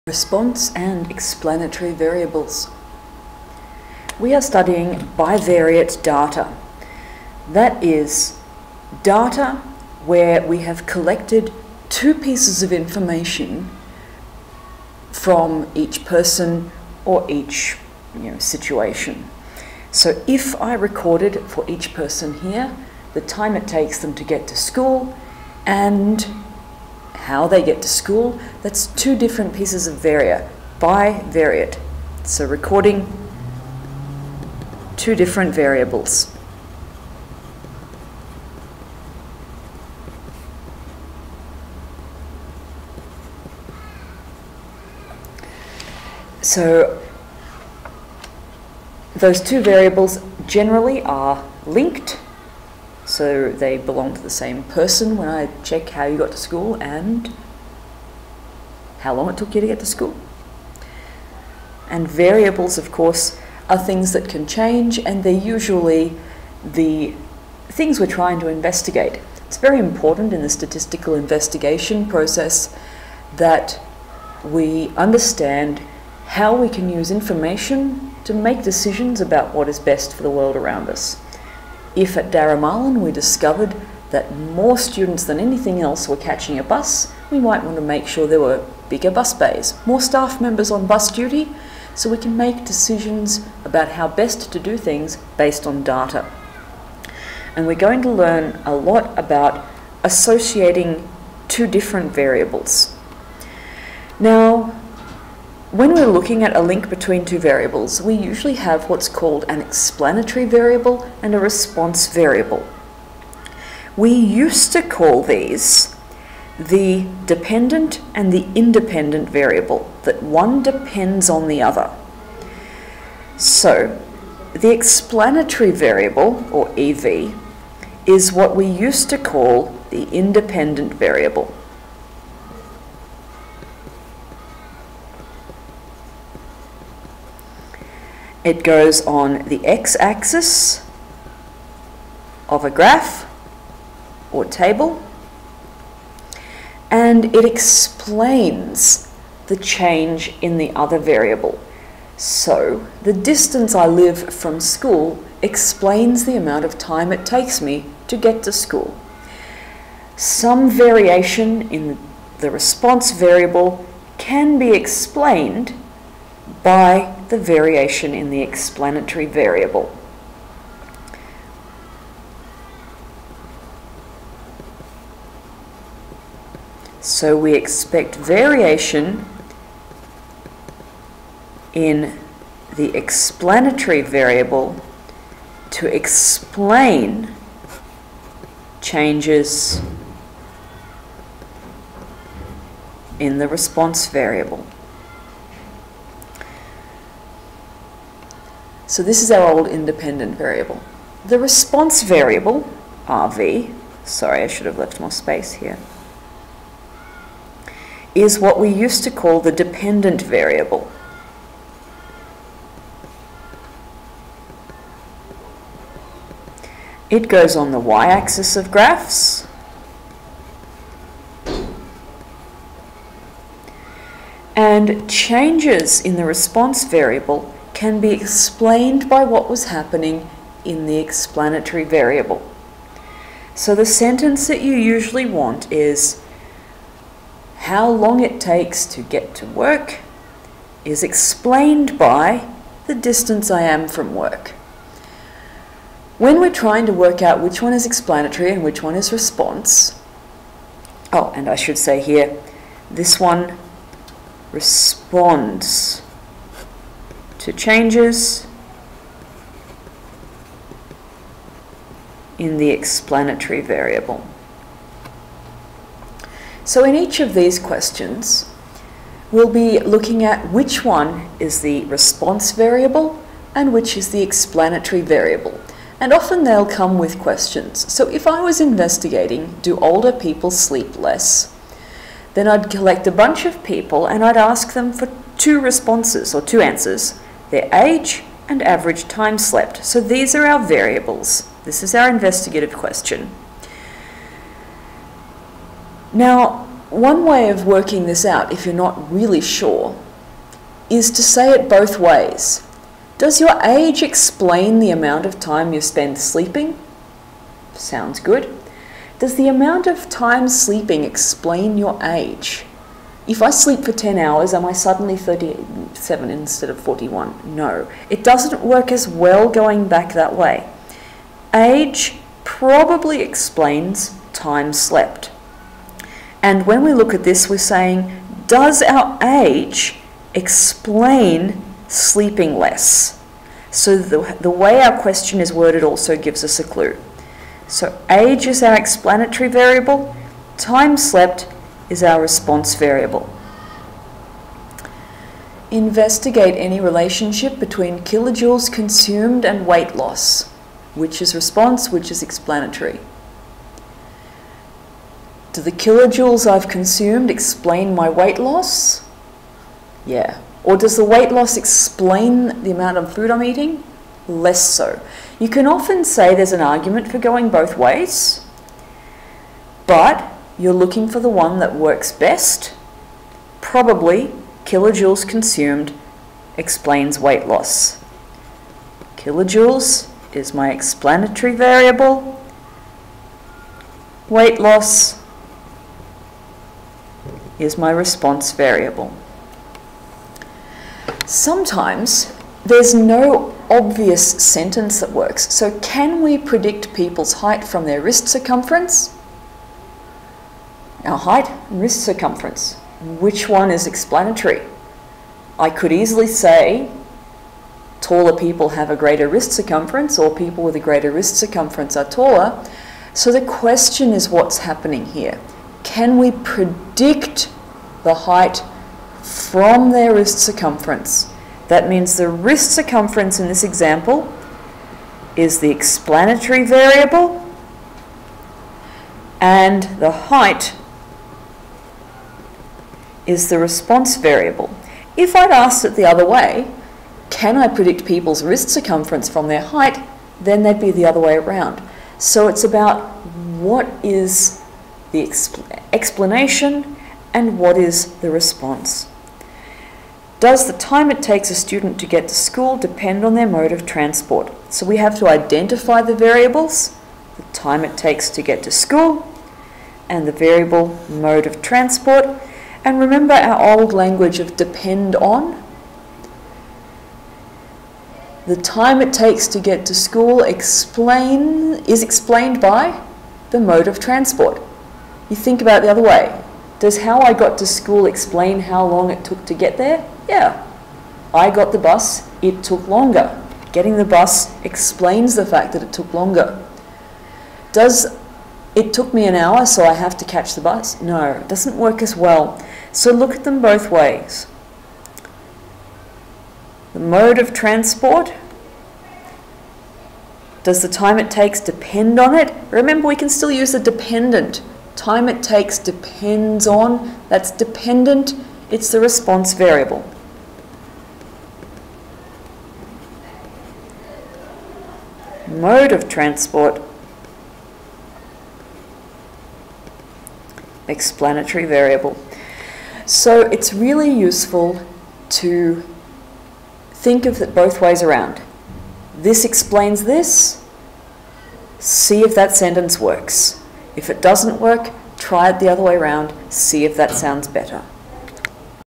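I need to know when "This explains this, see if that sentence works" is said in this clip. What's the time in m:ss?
8:49.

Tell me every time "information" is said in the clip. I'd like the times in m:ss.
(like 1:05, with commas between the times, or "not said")
0:12, 1:17.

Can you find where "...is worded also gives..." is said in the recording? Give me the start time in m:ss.
5:35.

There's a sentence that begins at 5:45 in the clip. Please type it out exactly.
Investigate any relationship between kilojoules consumed and weight loss, which is response, which is explanatory.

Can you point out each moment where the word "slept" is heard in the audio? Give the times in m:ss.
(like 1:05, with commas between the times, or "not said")
4:49, 5:24, 5:40.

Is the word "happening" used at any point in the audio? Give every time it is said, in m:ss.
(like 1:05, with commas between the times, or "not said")
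3:49, 6:54.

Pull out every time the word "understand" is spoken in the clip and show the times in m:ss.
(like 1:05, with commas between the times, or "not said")
1:14.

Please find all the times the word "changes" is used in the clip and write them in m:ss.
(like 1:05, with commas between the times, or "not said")
1:04, 2:29, 3:08, 3:45, 4:17.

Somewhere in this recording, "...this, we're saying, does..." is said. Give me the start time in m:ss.
5:27.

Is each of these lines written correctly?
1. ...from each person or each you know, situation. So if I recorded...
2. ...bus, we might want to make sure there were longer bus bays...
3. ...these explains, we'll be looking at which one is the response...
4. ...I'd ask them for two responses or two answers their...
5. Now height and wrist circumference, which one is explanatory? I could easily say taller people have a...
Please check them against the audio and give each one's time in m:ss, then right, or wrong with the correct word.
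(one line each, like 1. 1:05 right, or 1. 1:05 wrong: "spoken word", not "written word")
1. 0:15 right
2. 1:26 wrong: "bigger", not "longer"
3. 4:27 wrong: "questions", not "explains"
4. 4:44 right
5. 6:41 right.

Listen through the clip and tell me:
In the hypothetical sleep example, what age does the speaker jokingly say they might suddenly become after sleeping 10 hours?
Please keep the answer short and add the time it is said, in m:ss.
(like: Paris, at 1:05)
37, at 5:15.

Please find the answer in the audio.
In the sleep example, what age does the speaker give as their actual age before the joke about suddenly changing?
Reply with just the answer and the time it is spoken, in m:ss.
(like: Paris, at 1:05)
41, at 5:16.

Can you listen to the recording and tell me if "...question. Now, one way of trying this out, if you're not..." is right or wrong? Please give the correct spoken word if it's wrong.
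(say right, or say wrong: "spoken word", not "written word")
wrong: "working", not "trying".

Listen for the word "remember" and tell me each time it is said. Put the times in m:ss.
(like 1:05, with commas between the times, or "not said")
7:42, 8:22.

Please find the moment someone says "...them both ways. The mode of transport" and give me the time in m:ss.
8:13.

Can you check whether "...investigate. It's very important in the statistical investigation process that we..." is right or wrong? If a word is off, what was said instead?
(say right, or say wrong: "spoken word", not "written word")
right.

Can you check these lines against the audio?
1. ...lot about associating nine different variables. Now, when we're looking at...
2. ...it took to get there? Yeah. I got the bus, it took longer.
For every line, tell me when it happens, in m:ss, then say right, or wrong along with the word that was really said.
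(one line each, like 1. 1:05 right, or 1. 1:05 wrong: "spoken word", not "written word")
1. 1:38 wrong: "two", not "nine"
2. 7:59 right.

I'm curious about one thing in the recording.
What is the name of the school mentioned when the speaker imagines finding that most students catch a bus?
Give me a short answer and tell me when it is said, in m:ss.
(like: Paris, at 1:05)
Daramalan, at 1:22.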